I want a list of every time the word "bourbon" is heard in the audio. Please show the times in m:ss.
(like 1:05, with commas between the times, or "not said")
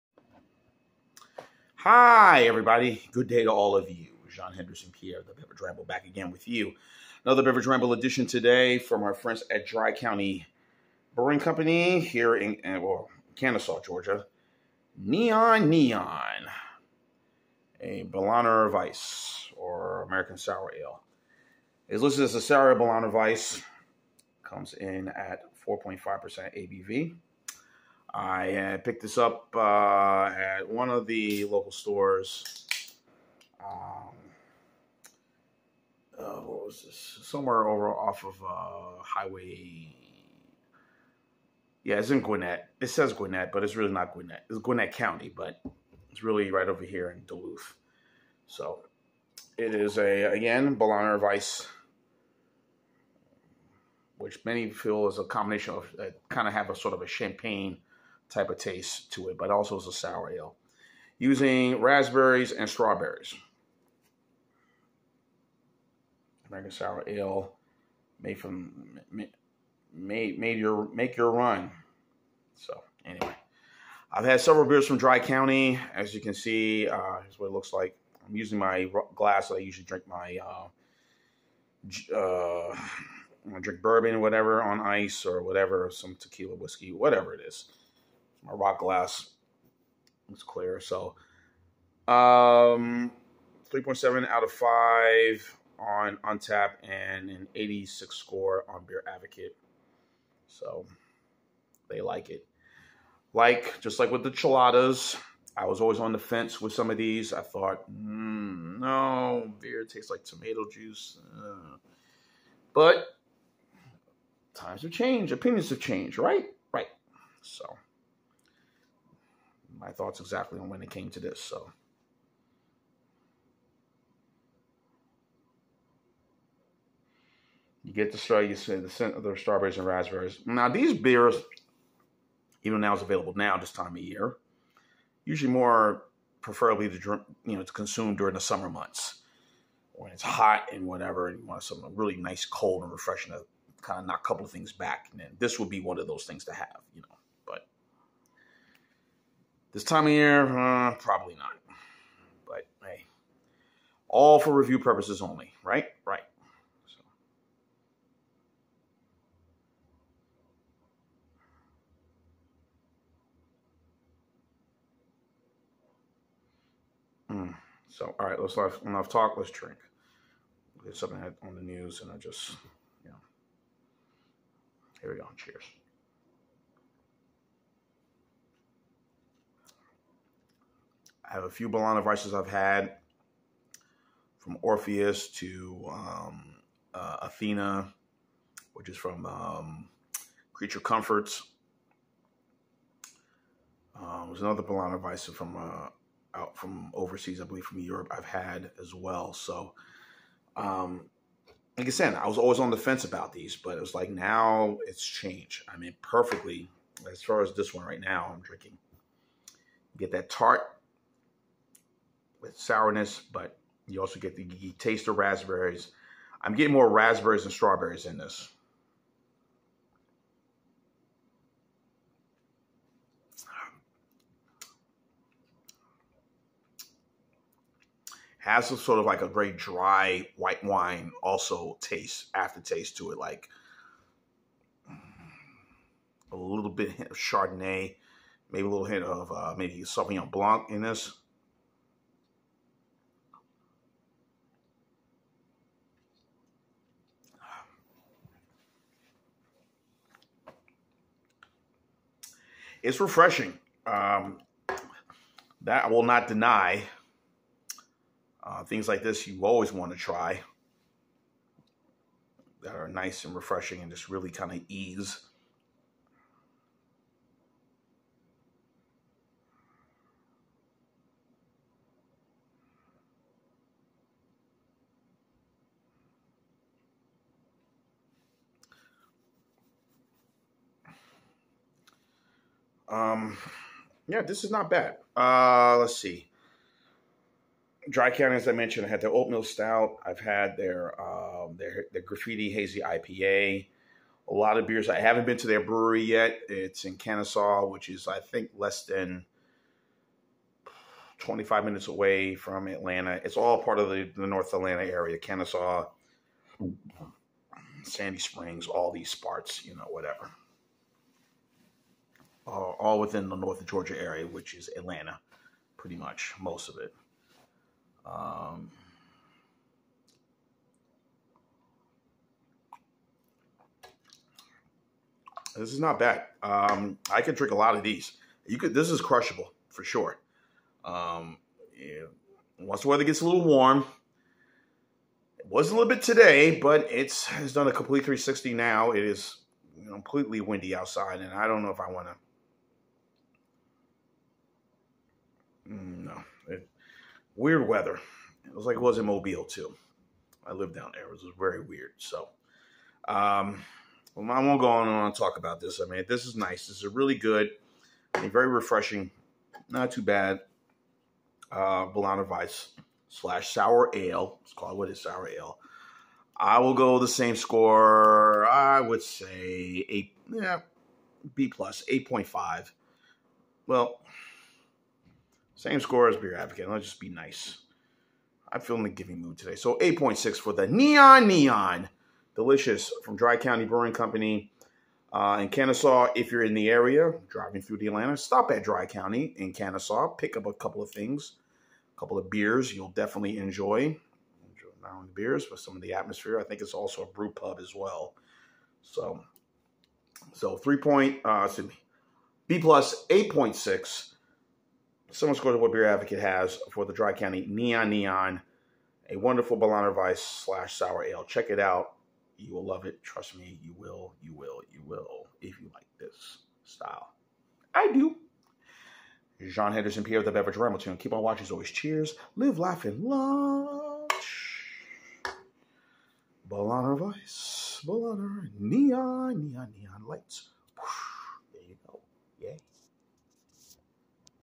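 1:23.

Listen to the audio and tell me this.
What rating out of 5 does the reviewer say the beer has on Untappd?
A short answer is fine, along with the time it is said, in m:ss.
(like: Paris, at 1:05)
3.7, at 1:33.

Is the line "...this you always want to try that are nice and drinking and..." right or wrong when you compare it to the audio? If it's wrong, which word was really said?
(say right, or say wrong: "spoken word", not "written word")
wrong: "refreshing", not "drinking".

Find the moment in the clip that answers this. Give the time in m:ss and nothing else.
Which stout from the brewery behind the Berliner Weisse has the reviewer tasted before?
4:49.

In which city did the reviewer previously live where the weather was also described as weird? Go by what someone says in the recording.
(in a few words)
Mobile.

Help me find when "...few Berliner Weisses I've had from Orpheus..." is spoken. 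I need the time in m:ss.
3:01.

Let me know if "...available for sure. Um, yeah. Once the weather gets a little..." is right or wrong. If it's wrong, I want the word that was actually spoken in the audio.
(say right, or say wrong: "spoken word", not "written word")
wrong: "crushable", not "available".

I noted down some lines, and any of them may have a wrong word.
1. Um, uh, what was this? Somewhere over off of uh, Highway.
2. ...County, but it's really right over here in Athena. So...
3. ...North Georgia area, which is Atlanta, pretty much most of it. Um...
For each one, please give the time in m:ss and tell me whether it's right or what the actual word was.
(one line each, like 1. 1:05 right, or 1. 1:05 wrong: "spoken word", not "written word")
1. 0:33 right
2. 0:44 wrong: "Duluth", not "Athena"
3. 5:13 right.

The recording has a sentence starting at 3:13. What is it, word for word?
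Um, there's another Berliner Weisse from uh, out from overseas, I believe from Europe, I've had as well.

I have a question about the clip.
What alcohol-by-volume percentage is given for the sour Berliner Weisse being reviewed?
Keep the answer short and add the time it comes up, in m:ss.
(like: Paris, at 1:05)
4.5%, at 0:25.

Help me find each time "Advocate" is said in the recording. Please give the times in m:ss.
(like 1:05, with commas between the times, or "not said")
1:39, 6:16, 6:45.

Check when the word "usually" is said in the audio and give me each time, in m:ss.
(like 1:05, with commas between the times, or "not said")
1:19, 2:15.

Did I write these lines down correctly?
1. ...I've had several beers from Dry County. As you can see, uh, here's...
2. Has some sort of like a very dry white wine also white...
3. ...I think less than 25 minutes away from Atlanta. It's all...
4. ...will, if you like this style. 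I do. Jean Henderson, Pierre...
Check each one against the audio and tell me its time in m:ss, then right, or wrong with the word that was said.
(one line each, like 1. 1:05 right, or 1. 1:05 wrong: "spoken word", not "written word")
1. 1:14 right
2. 3:48 wrong: "taste", not "white"
3. 4:58 right
4. 6:54 right.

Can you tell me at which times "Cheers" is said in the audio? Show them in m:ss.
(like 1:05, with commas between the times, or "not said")
2:55, 7:01.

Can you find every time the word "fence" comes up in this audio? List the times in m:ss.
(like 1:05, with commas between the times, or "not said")
1:46, 3:22.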